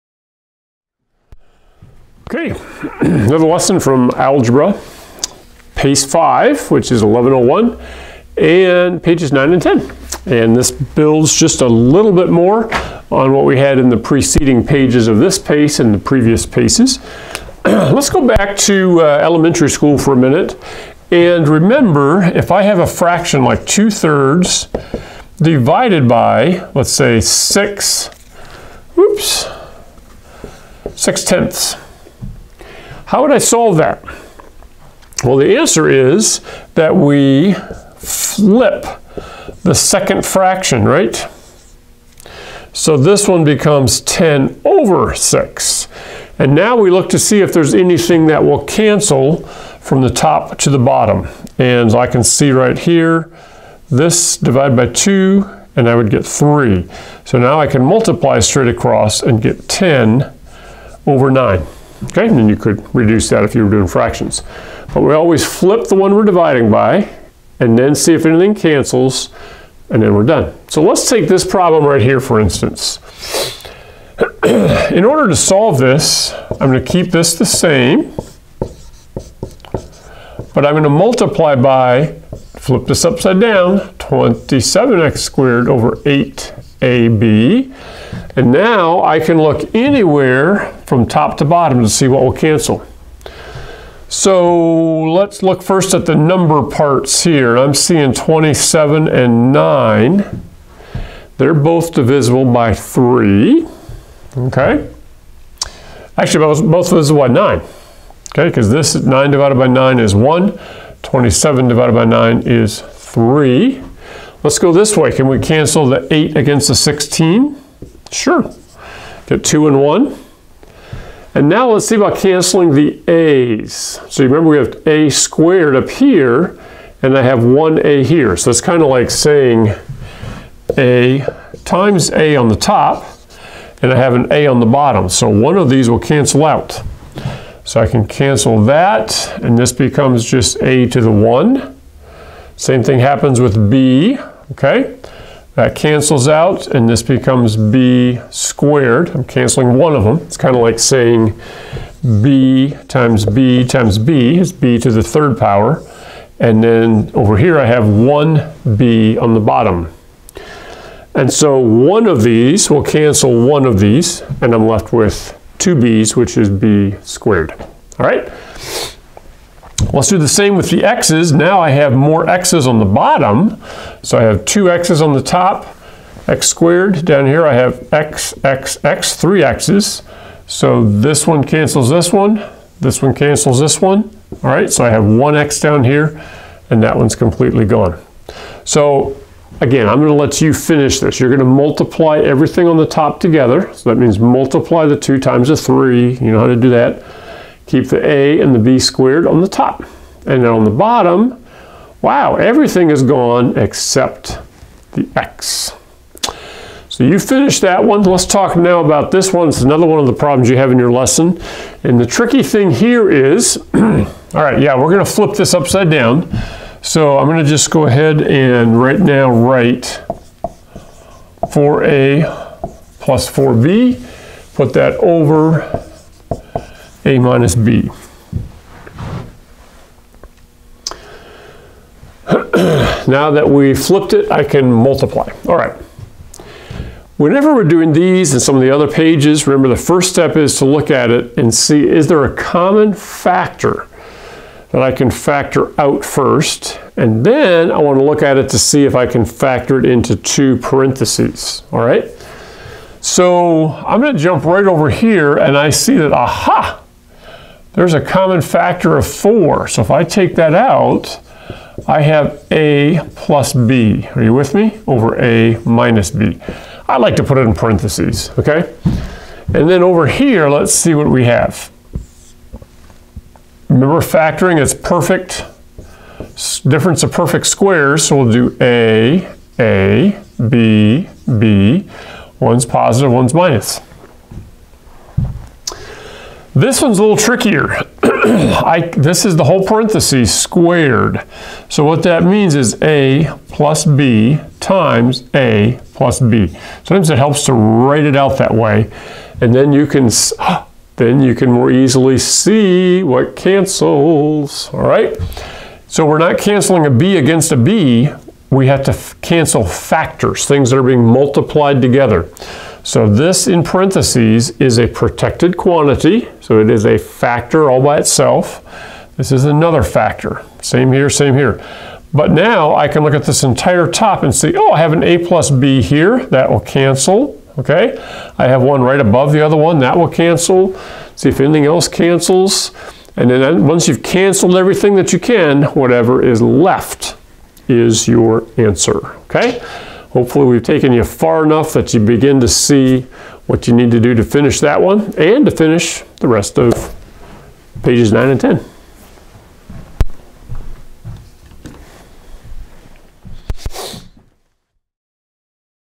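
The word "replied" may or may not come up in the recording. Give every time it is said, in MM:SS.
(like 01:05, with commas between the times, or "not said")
not said.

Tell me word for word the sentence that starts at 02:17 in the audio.
So I can cancel that, and this becomes just a to the 1.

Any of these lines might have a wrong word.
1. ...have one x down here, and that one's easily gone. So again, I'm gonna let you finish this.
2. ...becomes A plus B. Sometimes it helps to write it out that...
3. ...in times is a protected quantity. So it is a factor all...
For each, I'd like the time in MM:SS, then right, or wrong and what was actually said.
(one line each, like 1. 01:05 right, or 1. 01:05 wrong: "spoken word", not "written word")
1. 03:04 wrong: "completely", not "easily"
2. 04:54 wrong: "times", not "becomes"
3. 05:13 wrong: "parentheses", not "times".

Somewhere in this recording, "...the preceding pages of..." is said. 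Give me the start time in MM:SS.
00:13.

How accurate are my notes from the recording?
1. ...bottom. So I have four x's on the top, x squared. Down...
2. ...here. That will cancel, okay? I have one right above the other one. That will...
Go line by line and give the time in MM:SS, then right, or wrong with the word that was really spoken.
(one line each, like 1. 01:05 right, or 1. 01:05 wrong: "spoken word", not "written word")
1. 02:52 wrong: "two", not "four"
2. 05:25 right.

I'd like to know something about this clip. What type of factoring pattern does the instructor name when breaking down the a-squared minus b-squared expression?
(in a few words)
difference of perfect squares.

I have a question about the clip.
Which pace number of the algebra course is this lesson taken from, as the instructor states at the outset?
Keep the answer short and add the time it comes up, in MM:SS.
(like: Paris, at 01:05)
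1101, at 00:07.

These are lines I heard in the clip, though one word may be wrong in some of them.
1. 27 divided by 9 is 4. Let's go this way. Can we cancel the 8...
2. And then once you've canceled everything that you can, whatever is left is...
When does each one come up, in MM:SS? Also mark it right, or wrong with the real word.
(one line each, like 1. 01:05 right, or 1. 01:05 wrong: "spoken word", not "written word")
1. 01:51 wrong: "3", not "4"
2. 05:33 right.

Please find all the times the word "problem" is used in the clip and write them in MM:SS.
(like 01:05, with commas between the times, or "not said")
01:11, 03:30.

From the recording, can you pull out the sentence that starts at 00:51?
And I can see right here, this divided by 2, and I would get 3.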